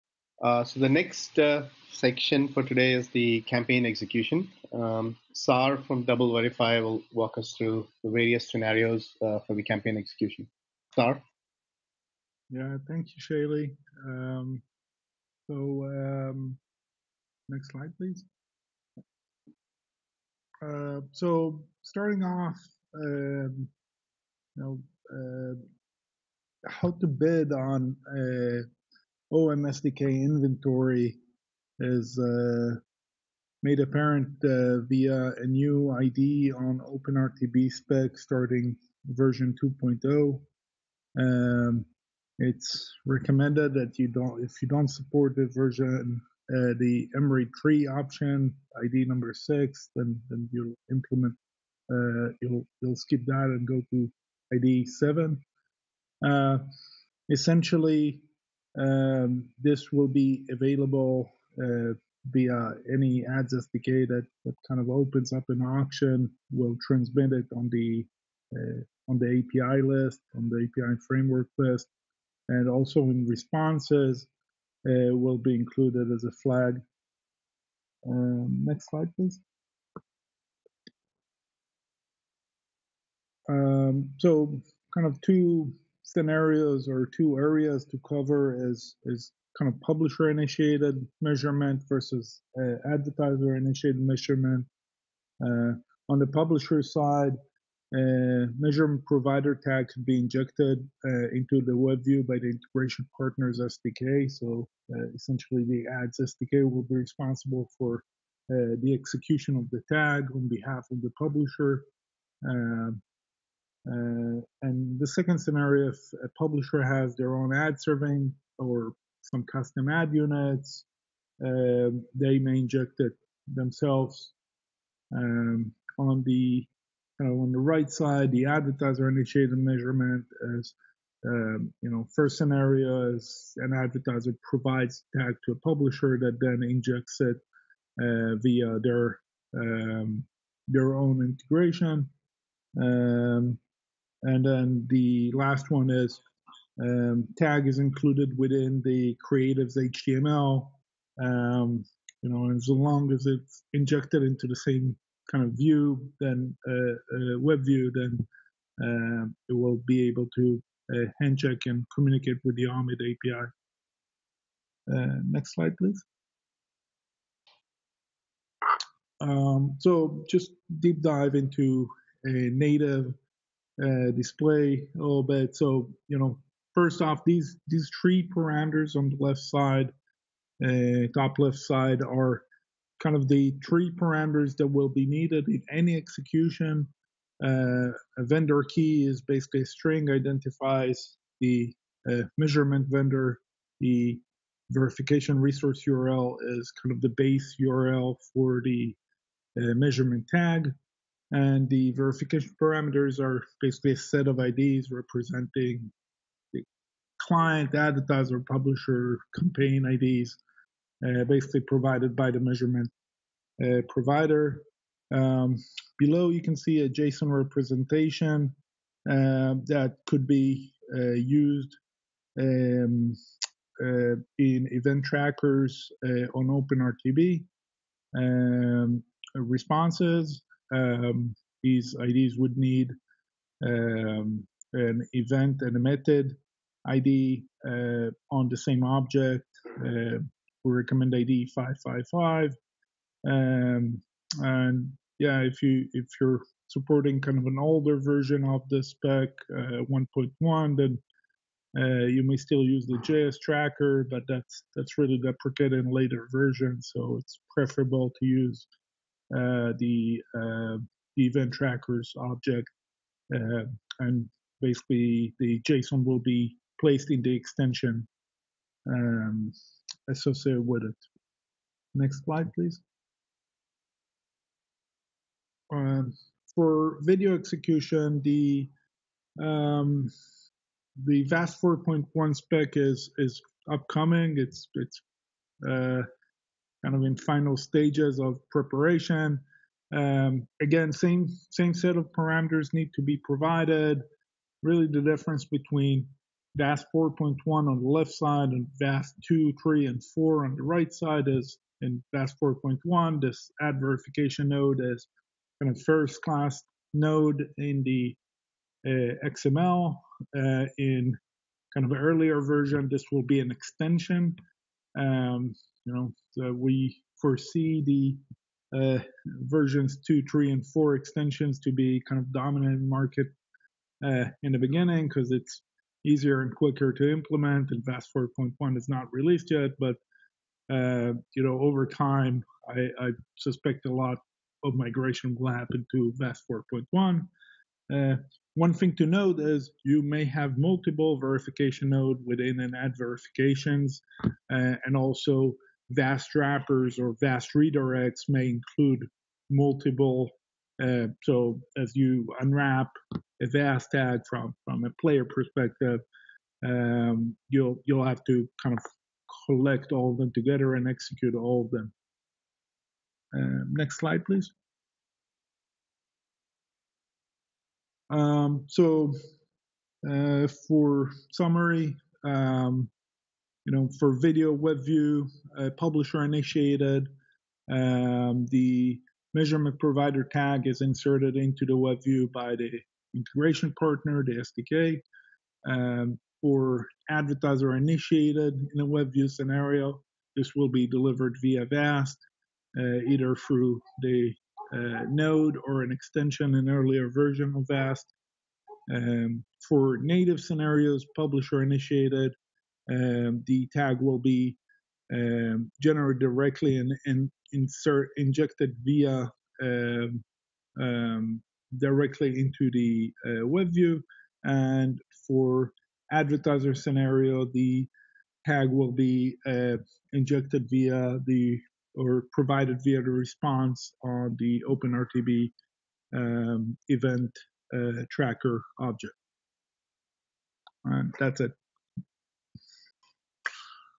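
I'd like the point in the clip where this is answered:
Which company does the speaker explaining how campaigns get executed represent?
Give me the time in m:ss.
0:06.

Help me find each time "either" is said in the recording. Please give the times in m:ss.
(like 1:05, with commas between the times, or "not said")
6:33.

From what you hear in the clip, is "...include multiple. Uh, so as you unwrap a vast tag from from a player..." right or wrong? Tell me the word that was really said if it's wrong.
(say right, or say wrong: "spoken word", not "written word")
right.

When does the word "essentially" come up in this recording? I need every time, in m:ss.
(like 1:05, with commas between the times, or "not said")
0:57, 1:45.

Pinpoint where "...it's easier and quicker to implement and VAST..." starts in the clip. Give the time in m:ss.
5:25.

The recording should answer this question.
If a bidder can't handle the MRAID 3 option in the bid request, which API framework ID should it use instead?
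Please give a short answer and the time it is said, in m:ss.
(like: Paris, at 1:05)
7, at 0:54.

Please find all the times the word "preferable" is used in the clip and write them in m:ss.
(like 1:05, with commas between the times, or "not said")
4:17.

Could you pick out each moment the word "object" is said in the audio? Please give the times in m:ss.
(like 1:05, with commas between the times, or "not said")
3:58, 4:22, 7:08.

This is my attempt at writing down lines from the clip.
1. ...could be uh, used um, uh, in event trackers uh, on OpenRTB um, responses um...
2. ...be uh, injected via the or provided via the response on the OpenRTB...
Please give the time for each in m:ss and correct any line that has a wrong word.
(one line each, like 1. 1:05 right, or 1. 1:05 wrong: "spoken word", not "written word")
1. 3:40 right
2. 6:58 right.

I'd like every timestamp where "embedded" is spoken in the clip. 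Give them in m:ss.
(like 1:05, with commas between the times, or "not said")
not said.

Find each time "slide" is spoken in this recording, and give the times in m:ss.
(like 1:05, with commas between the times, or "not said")
0:17, 1:18, 2:45, 4:32, 6:03.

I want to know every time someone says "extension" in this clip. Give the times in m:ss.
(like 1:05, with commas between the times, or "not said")
4:27, 5:13, 5:20, 6:35.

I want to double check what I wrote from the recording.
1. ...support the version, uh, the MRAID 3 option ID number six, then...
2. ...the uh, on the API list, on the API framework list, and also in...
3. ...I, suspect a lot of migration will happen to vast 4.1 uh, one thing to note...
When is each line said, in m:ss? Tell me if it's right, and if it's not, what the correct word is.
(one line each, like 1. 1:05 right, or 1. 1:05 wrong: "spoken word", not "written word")
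1. 0:44 right
2. 1:07 right
3. 5:33 right.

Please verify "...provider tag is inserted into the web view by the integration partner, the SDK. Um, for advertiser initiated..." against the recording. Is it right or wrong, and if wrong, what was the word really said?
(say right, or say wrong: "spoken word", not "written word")
right.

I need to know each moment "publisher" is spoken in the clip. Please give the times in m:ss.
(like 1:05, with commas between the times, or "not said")
1:29, 1:36, 1:51, 1:56, 2:15, 3:28, 6:15, 6:41.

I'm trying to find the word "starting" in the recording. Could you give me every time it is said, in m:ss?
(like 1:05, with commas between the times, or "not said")
0:21, 0:38.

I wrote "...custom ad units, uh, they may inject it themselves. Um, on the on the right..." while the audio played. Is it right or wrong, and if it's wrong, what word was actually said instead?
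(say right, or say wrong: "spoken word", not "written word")
right.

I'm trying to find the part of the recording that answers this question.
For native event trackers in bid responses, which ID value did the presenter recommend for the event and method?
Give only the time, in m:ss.
4:01.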